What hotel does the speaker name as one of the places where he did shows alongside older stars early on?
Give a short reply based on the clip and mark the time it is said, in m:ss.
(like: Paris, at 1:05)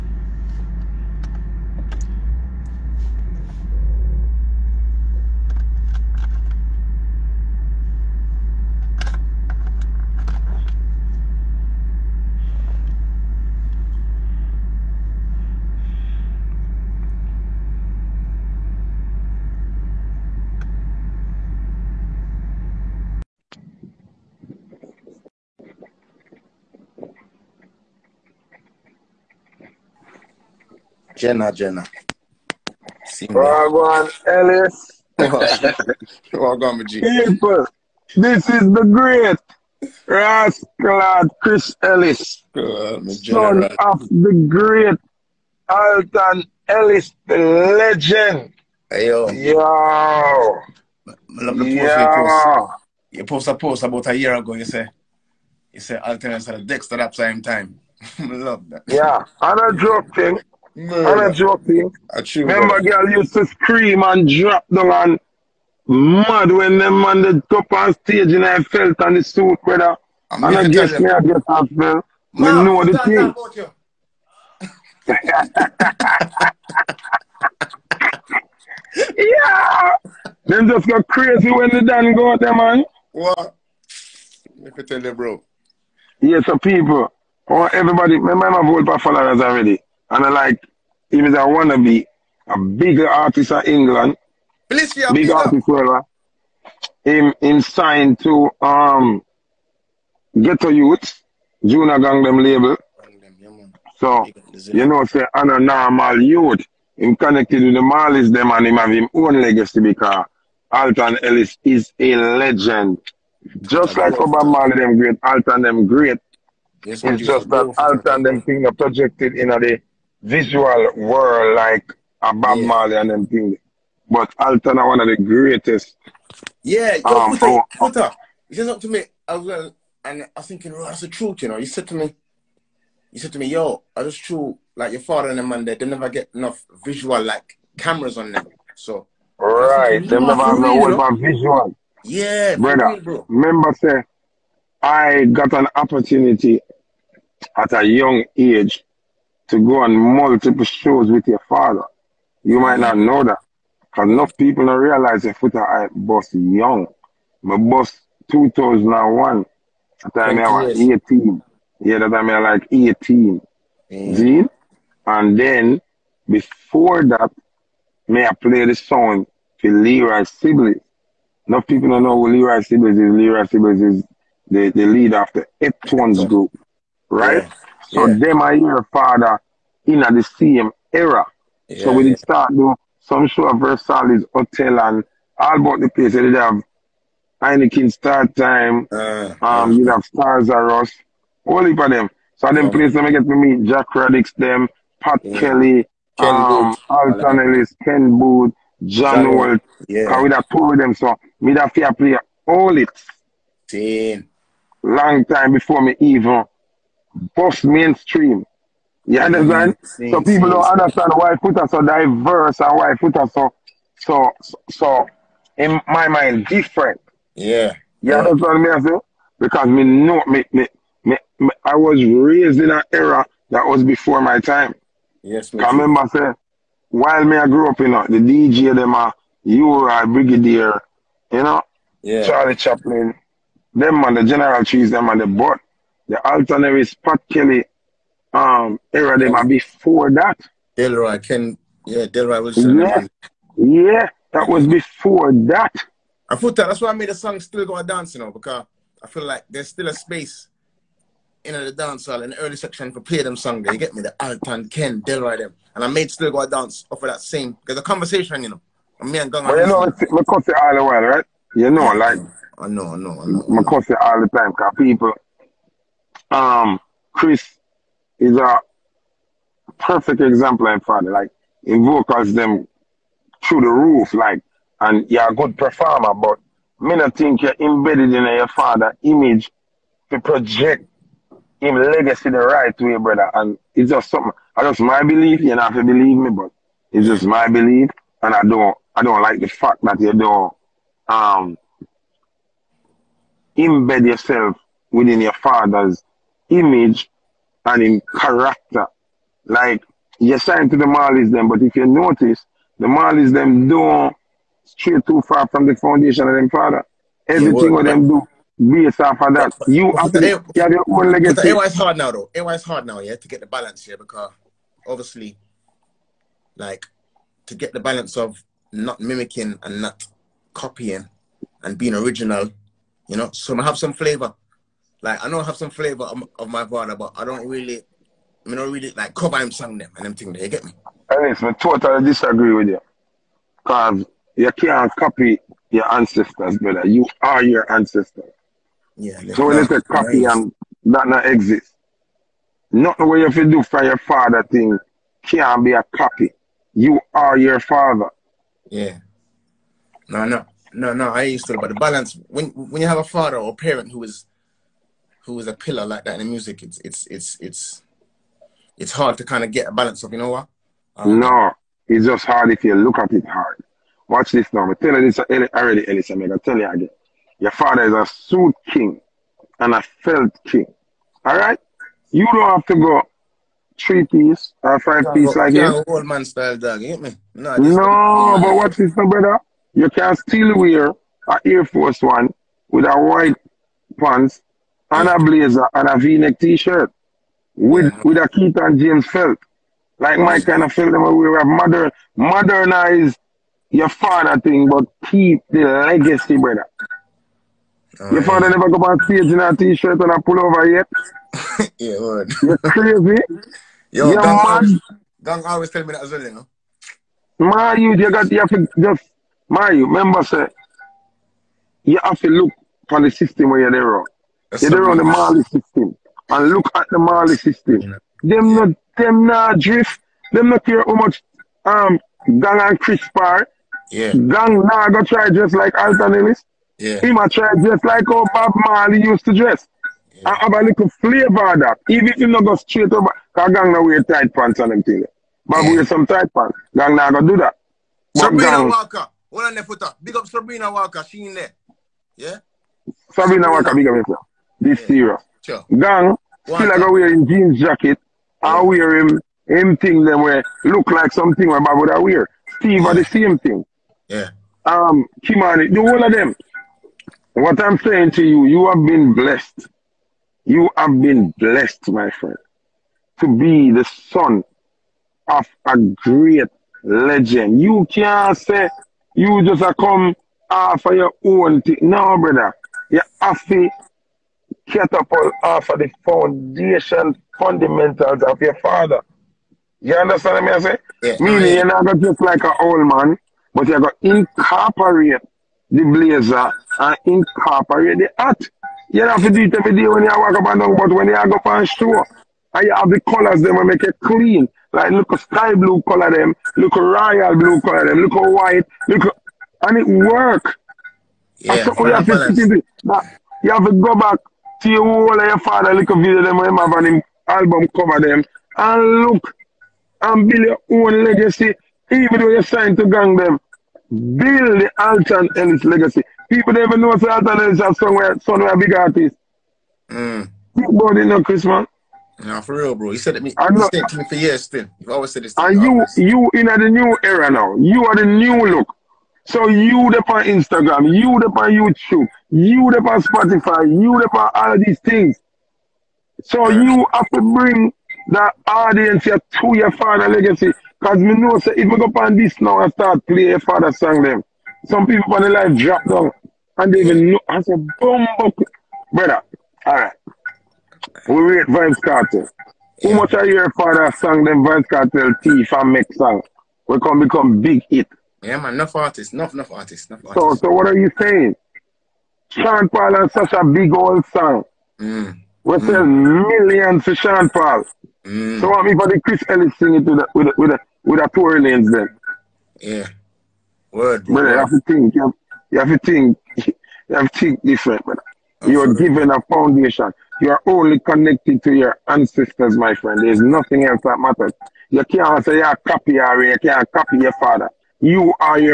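Versailles Hotel, at 3:03.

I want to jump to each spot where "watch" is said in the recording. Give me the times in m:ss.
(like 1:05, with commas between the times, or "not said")
6:04, 6:18.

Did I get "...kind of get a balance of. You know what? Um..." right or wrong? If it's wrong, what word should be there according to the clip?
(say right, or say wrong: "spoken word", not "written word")
right.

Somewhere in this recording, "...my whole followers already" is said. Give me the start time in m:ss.
1:28.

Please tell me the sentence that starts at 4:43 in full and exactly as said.
And it's just something, I just my belief, you don't have to believe me, but it's just my belief.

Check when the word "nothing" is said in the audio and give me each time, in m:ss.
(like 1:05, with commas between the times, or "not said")
5:42, 9:43.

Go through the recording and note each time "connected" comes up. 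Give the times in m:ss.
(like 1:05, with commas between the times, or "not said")
1:47, 9:40.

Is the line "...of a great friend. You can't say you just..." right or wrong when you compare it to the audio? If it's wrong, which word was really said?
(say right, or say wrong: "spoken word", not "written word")
wrong: "legend", not "friend".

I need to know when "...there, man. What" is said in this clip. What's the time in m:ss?
1:22.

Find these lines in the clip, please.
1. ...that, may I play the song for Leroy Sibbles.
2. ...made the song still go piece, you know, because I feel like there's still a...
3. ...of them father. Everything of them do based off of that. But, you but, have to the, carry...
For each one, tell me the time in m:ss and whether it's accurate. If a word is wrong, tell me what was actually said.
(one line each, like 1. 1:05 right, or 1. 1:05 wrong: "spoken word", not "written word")
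1. 2:47 right
2. 4:06 wrong: "dance", not "piece"
3. 5:06 right.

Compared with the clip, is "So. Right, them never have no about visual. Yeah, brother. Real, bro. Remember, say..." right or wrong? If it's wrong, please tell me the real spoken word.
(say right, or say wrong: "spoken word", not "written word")
right.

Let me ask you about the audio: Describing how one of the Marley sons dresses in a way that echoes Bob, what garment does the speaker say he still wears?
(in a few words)
jeans jacket.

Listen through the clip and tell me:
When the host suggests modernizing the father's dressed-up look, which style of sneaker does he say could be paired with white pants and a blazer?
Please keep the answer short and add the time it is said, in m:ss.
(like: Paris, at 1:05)
Air Force One, at 6:21.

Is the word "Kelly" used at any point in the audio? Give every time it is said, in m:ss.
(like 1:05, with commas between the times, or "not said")
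3:15, 3:57.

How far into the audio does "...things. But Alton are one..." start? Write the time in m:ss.
2:03.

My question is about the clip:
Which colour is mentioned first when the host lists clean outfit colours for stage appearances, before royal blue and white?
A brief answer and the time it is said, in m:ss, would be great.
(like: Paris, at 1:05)
sky blue, at 8:15.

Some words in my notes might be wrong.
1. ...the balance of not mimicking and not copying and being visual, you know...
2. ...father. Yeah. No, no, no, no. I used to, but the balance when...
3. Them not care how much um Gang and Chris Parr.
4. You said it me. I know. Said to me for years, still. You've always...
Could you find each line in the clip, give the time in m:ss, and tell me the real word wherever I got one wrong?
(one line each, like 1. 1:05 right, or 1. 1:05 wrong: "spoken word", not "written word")
1. 5:17 wrong: "original", not "visual"
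2. 5:47 right
3. 7:00 right
4. 8:42 right.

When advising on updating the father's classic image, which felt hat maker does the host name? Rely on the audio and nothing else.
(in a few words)
Keith and James.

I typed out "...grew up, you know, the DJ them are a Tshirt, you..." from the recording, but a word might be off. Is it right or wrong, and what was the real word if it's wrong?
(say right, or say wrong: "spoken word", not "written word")
wrong: "Brigadier", not "Tshirt".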